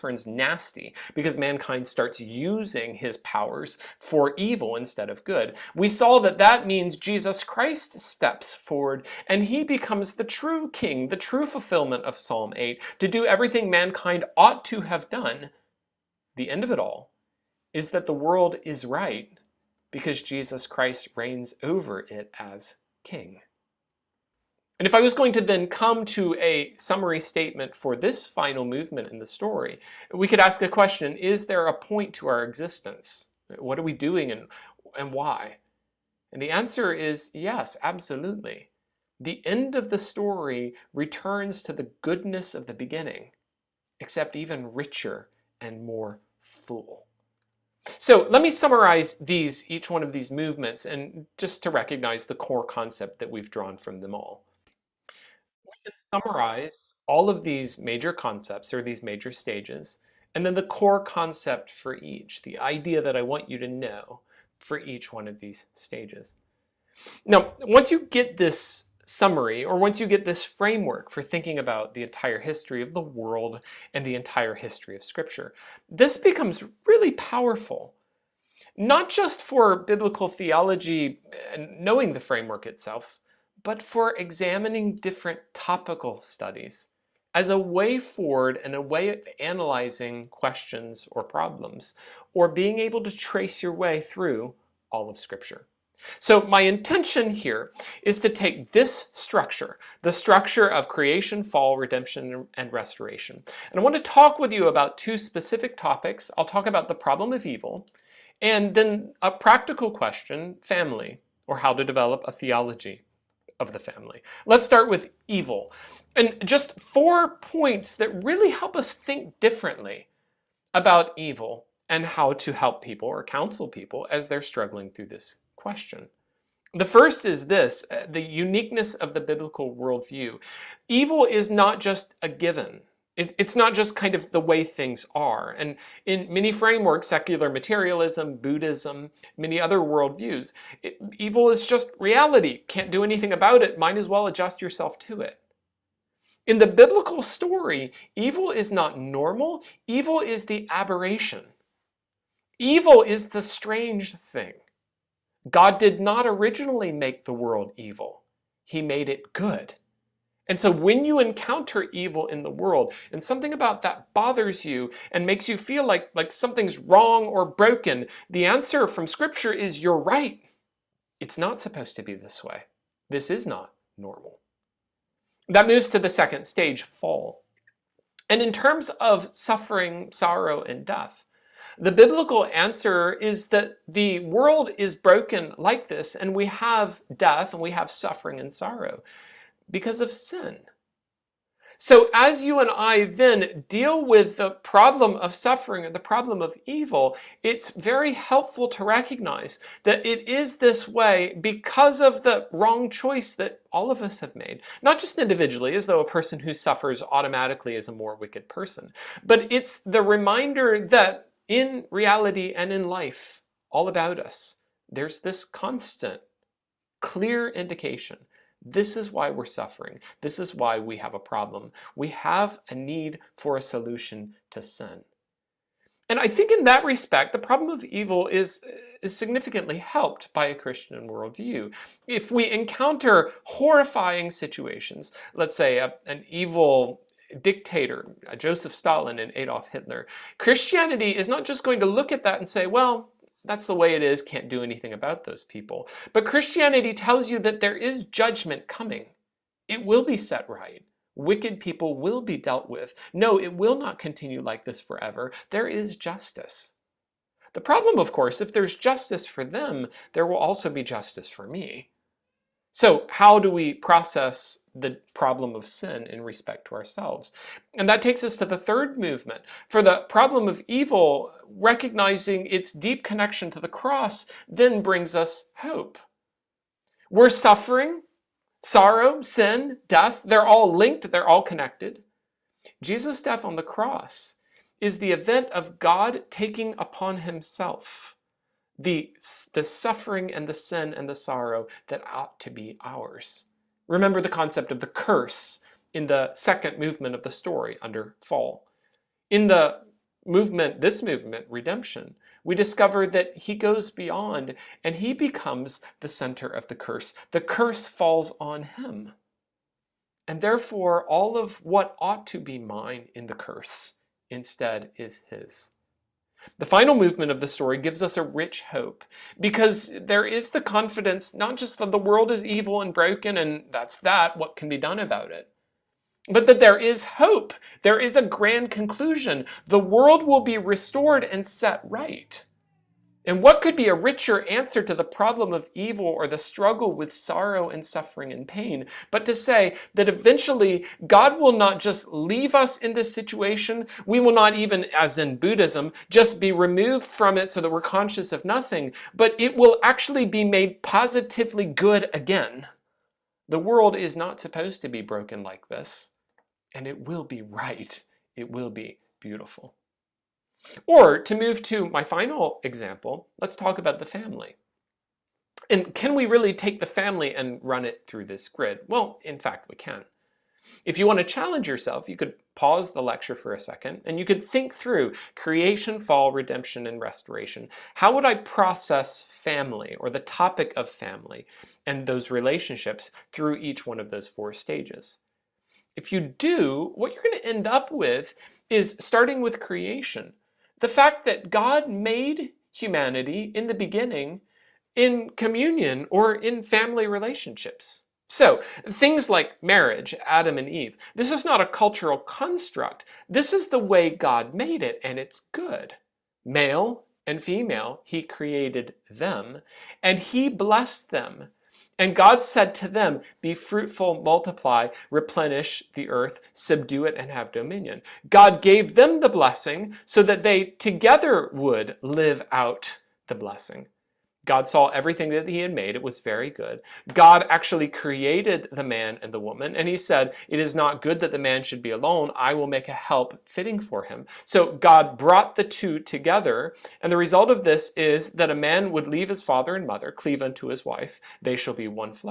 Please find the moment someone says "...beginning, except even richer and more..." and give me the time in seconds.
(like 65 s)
42 s.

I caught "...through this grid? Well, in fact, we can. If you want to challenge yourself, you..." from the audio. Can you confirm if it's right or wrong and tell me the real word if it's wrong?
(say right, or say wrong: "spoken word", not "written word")
right.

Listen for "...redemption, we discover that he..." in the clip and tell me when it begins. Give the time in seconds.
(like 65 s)
301 s.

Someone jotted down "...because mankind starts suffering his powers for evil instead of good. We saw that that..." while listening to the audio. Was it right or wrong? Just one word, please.
wrong.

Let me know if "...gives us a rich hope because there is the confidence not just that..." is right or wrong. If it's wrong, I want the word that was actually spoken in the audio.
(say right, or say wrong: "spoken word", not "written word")
right.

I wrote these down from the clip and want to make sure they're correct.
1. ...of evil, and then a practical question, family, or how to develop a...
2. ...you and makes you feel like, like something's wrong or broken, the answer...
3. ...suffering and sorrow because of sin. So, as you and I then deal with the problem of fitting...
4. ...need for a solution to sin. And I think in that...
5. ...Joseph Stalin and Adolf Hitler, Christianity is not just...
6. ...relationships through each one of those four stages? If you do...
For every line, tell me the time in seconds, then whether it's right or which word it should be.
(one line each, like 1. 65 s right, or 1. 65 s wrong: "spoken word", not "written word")
1. 107 s right
2. 164 s right
3. 187 s wrong: "suffering", not "fitting"
4. 222 s right
5. 238 s right
6. 382 s right.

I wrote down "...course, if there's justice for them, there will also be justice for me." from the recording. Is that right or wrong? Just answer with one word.
right.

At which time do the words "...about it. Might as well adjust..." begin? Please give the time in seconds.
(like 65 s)
143 s.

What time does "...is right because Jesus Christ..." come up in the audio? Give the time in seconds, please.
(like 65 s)
18 s.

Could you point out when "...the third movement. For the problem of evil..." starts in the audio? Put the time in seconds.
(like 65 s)
268 s.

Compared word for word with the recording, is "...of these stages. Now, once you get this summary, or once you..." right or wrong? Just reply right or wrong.
right.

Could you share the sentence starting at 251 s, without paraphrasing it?
Wicked people will be dealt with.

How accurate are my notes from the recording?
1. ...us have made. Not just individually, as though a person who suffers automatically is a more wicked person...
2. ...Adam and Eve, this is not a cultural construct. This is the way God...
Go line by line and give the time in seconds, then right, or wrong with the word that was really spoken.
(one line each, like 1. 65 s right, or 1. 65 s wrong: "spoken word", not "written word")
1. 204 s right
2. 400 s right.